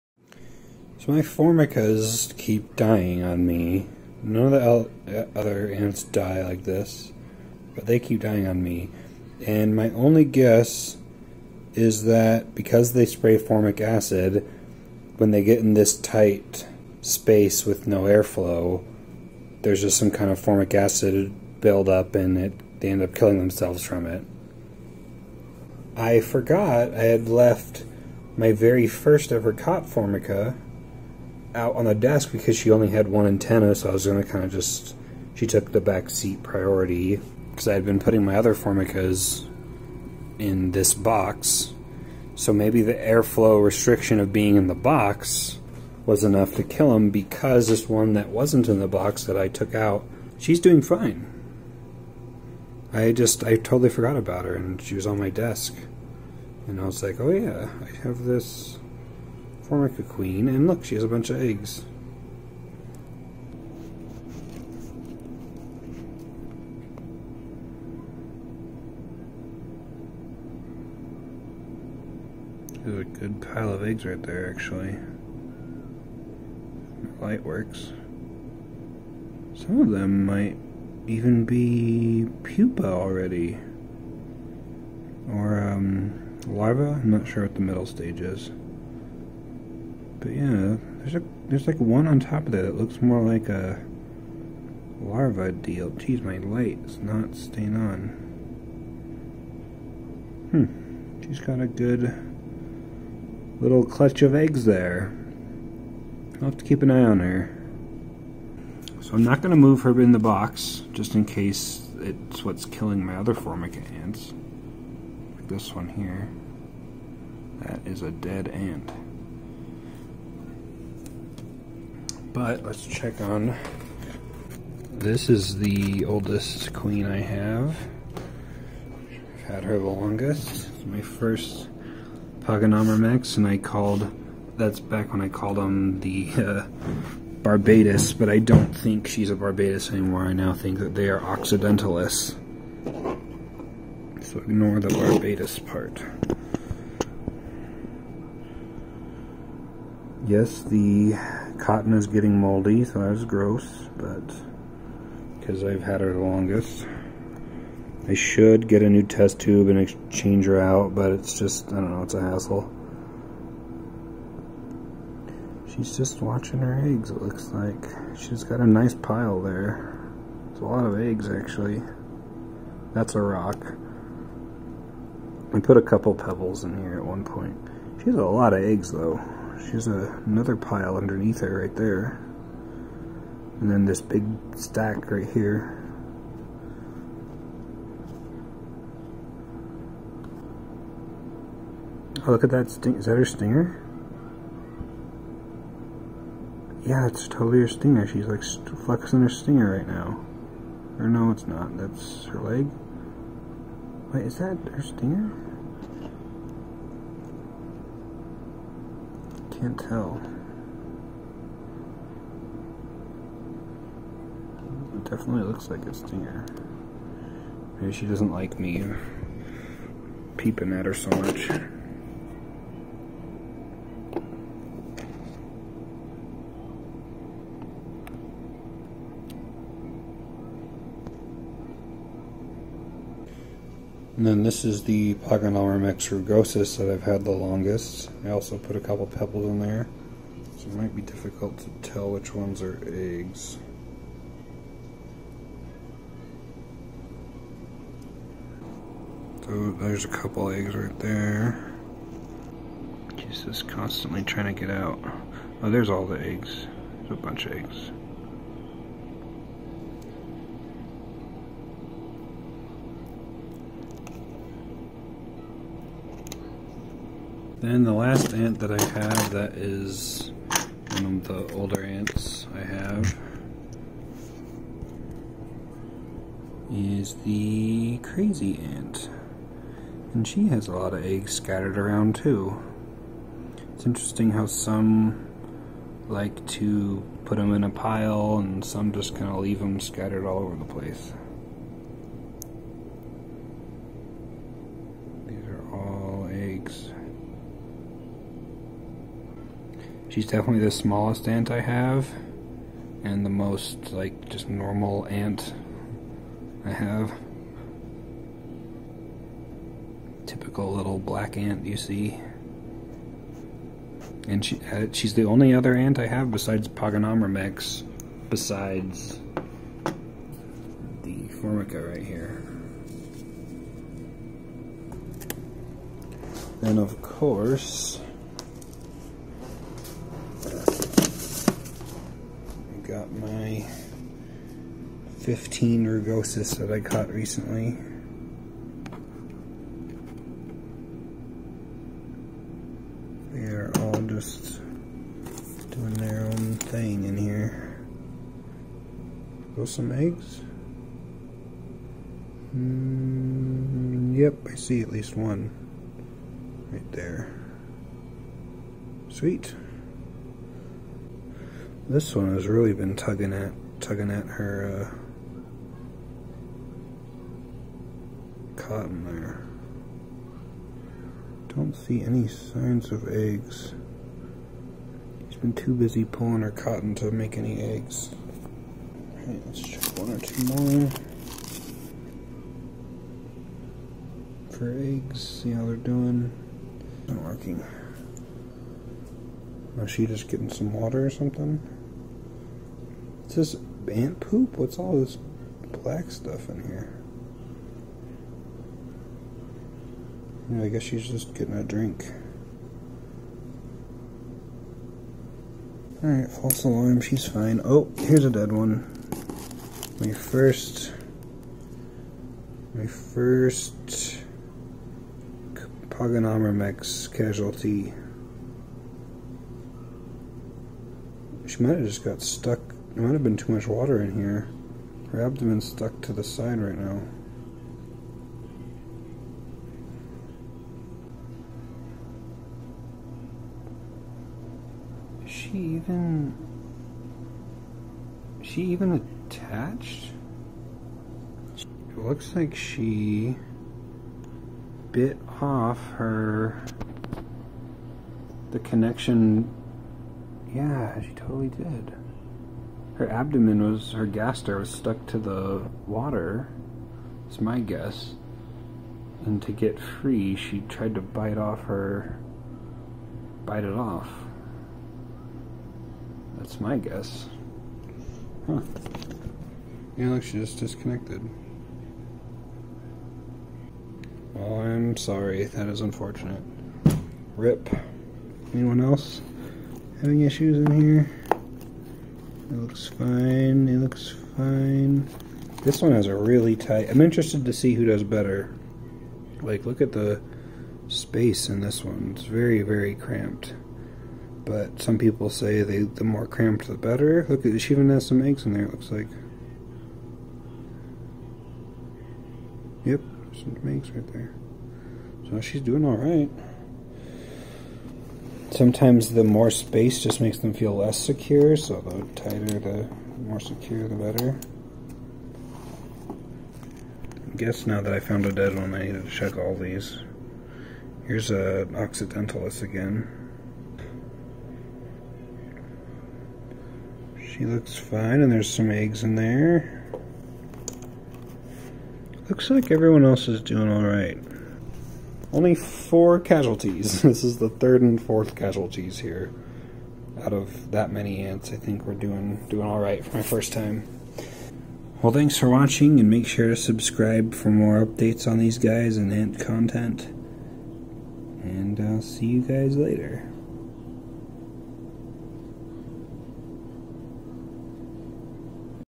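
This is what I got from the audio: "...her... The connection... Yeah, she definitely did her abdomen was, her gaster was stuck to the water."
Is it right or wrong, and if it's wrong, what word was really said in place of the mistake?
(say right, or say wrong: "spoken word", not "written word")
wrong: "totally", not "definitely".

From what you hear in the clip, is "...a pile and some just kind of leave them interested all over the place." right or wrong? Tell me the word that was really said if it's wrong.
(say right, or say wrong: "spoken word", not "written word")
wrong: "scattered", not "interested".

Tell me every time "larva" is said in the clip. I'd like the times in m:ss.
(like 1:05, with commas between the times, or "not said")
1:26, 1:35.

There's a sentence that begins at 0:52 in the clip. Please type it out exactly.
I just, I totally forgot about her and she was on my desk.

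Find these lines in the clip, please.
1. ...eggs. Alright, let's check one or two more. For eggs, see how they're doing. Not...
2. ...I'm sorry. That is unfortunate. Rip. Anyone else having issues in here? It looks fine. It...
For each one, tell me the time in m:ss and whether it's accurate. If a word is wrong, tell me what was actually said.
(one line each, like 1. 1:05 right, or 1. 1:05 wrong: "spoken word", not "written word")
1. 6:17 right
2. 7:54 right.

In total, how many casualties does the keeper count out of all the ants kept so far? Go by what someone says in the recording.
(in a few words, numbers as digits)
4.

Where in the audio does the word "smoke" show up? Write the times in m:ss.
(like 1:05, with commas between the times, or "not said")
not said.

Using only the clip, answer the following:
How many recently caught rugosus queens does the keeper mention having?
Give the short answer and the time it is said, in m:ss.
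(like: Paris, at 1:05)
15, at 5:35.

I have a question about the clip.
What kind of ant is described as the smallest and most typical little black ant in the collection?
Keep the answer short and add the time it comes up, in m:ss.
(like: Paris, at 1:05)
Crazy ant, at 4:38.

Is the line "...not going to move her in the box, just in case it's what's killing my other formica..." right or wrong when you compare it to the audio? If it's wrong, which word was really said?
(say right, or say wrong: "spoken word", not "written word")
right.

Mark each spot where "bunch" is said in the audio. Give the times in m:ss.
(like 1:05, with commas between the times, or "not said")
1:01, 4:17.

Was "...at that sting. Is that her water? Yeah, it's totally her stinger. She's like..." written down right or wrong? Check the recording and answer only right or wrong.
wrong.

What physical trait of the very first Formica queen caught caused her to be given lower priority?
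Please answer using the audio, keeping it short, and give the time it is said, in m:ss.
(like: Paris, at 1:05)
One antenna, at 0:32.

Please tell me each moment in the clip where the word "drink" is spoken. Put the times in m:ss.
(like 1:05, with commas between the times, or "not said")
6:41.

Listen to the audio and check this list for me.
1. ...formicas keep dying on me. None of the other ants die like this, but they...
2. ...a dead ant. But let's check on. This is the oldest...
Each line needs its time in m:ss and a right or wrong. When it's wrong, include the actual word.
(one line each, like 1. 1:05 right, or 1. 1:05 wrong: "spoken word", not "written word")
1. 0:01 right
2. 1:58 right.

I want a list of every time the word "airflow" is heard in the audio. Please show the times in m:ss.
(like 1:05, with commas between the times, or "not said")
0:18, 0:42.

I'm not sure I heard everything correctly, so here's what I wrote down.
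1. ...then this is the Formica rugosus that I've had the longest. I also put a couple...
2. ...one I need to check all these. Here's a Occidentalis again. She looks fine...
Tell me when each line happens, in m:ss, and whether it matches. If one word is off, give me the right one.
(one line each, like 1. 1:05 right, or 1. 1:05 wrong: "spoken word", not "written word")
1. 3:54 wrong: "Pogonomyrmex", not "Formica"
2. 8:38 right.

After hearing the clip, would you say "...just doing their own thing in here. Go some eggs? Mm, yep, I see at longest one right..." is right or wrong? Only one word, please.
wrong.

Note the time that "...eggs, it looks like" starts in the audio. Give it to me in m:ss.
2:46.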